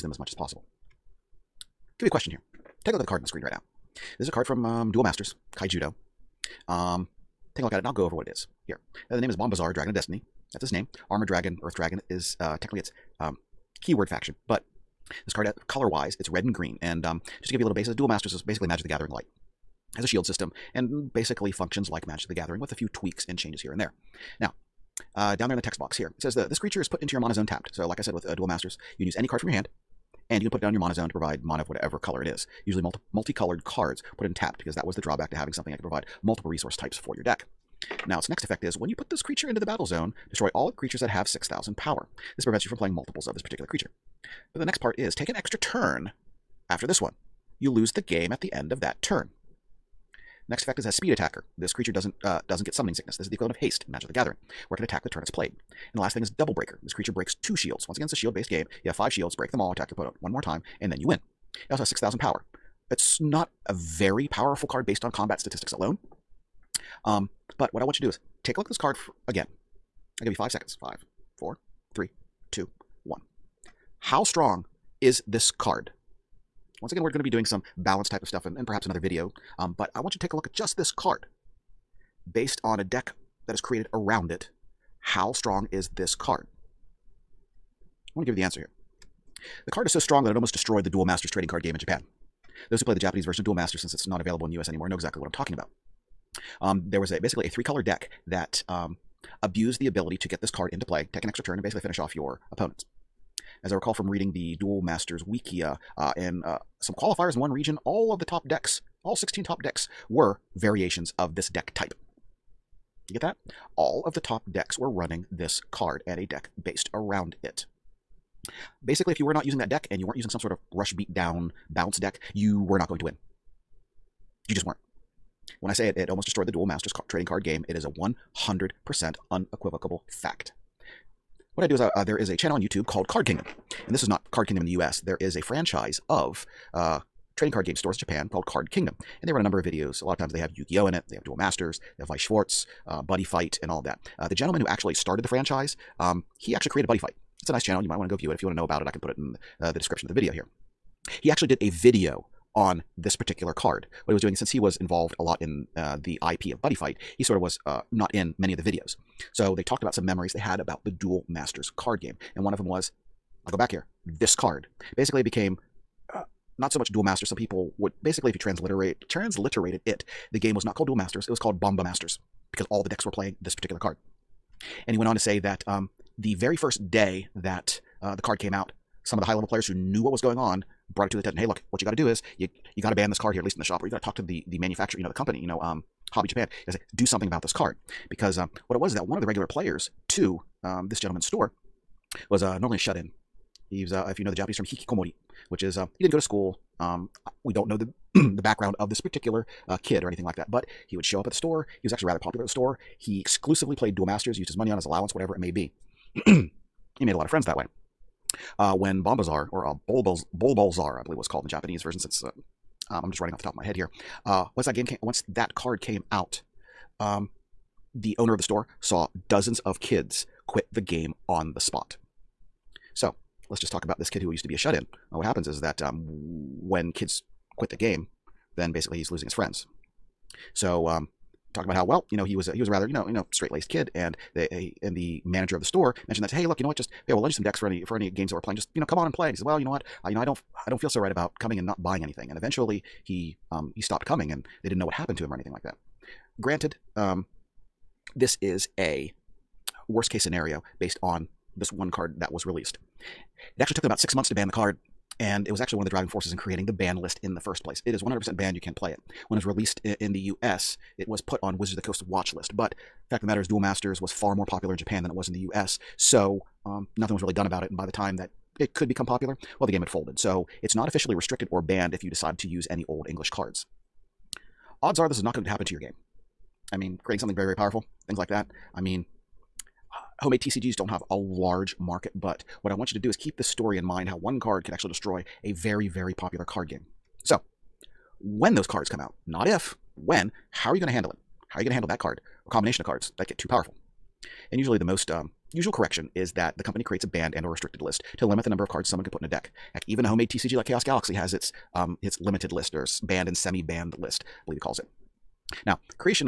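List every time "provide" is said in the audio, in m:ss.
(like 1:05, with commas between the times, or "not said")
0:31, 0:35.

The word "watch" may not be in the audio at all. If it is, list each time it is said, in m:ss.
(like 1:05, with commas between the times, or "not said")
4:22.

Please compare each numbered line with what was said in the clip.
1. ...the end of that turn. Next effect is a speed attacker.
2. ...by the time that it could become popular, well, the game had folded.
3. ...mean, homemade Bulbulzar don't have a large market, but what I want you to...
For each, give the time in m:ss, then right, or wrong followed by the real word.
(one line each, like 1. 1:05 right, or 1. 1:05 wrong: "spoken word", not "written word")
1. 0:48 right
2. 4:27 right
3. 4:38 wrong: "TCGs", not "Bulbulzar".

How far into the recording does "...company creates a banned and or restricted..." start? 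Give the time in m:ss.
4:56.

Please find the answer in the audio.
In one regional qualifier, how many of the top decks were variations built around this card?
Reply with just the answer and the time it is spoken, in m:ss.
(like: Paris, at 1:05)
16, at 1:49.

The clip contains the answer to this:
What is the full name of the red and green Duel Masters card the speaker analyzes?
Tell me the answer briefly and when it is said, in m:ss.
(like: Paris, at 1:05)
Bombazar, Dragon of Destiny, at 0:09.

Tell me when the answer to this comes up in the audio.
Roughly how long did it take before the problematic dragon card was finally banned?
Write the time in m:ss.
4:13.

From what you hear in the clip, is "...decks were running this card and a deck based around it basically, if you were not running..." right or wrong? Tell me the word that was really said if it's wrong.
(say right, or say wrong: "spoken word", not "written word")
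wrong: "using", not "running".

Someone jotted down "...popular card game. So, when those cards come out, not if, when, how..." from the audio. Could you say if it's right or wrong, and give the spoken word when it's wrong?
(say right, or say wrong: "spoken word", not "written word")
right.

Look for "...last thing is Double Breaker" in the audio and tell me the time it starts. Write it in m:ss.
0:56.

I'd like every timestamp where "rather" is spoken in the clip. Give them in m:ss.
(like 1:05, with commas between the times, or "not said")
3:22, 3:52.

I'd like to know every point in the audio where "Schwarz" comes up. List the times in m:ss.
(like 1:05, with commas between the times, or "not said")
2:22.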